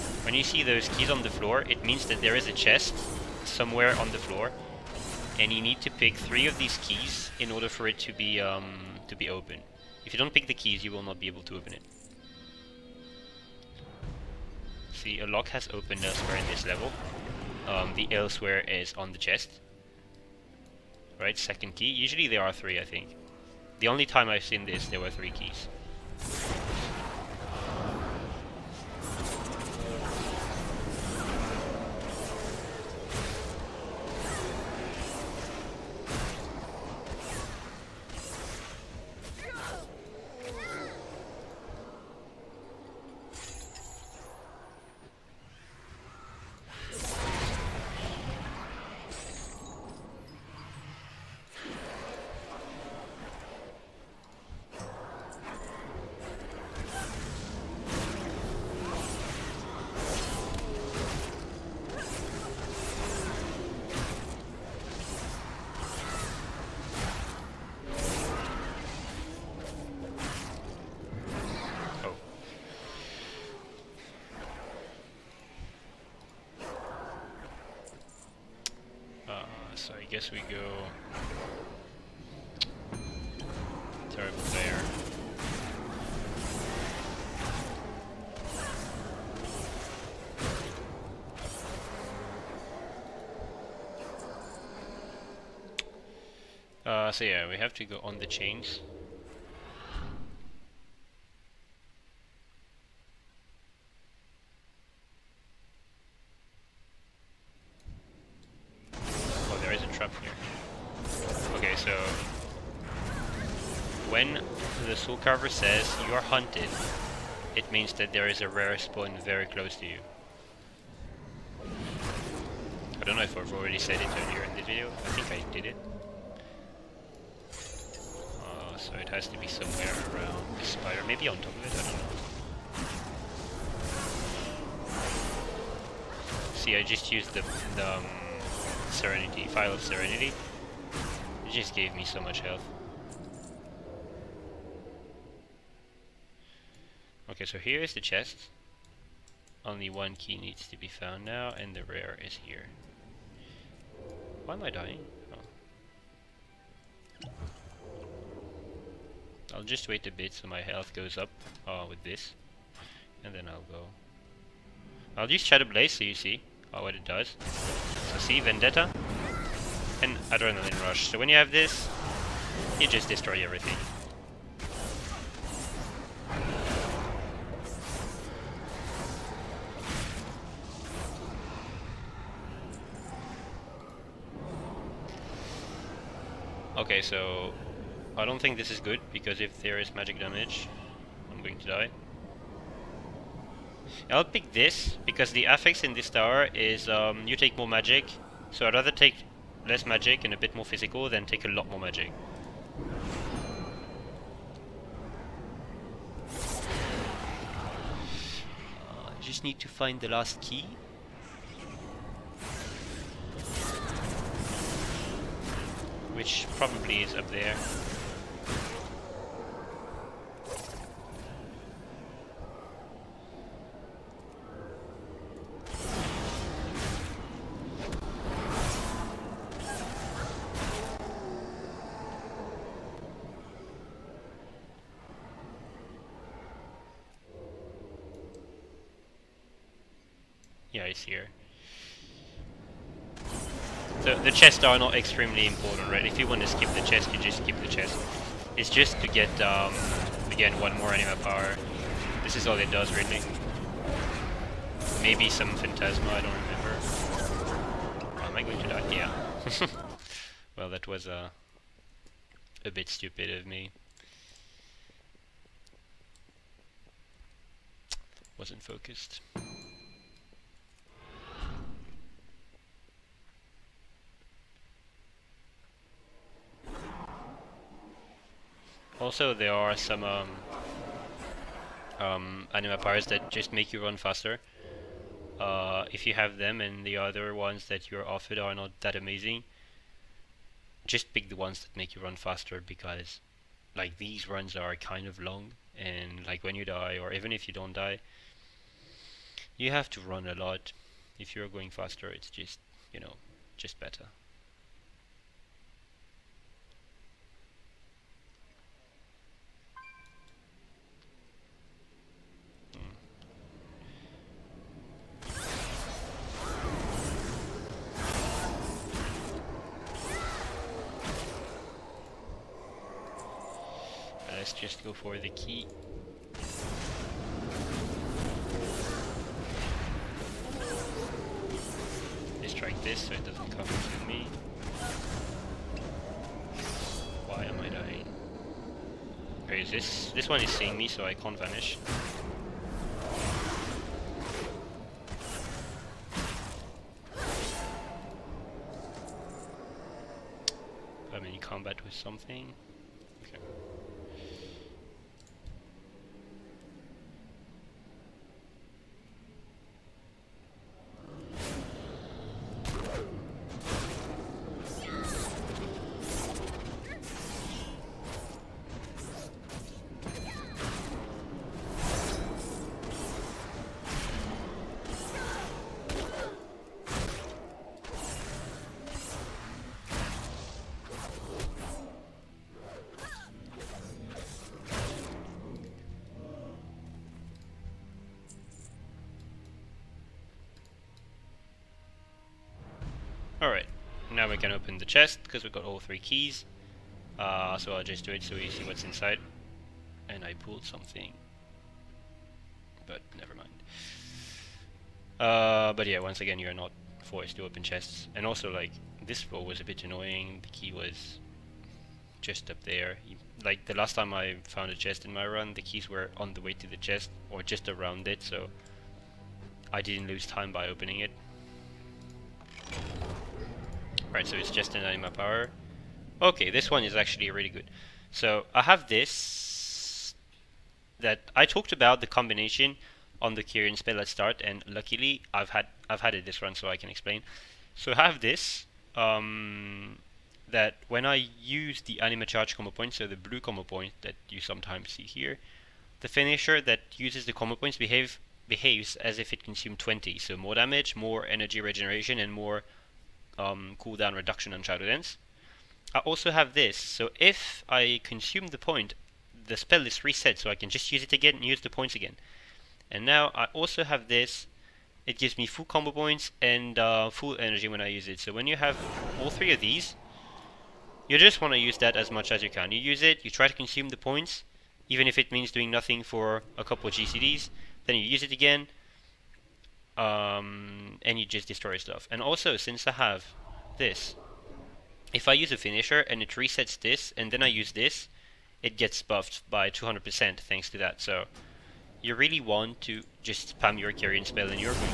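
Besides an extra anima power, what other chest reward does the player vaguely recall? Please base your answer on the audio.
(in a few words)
Phantasma.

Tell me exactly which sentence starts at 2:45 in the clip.
I'll use Shadow Blades so you see uh, what it does.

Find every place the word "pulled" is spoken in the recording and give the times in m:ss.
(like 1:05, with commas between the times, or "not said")
6:40.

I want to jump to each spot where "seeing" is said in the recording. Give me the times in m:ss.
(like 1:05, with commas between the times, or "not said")
5:40.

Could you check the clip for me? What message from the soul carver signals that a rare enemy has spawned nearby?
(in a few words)
You are hunted.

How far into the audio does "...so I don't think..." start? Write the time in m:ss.
3:07.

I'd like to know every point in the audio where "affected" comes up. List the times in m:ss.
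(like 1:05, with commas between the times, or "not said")
not said.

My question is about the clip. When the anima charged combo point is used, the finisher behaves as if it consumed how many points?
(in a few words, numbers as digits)
20.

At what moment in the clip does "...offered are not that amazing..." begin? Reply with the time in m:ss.
4:48.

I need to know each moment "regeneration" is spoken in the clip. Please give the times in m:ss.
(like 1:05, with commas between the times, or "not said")
7:31.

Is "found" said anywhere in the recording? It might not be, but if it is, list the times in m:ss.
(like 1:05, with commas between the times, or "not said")
2:30, 6:54.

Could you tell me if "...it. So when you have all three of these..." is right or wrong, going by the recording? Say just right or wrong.
right.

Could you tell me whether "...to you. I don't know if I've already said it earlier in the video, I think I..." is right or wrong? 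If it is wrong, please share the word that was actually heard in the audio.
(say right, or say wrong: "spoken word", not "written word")
right.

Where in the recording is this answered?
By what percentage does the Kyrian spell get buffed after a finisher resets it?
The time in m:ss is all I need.
8:09.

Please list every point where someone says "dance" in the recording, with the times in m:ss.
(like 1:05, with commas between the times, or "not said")
7:34.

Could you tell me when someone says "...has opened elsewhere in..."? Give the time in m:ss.
0:15.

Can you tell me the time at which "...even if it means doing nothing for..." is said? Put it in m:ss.
7:54.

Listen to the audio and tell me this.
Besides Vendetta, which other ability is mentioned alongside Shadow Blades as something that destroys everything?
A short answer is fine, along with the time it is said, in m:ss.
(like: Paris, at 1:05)
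Adrenaline Rush, at 2:50.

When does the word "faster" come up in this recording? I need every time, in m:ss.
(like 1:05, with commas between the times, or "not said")
4:43, 4:52, 5:01.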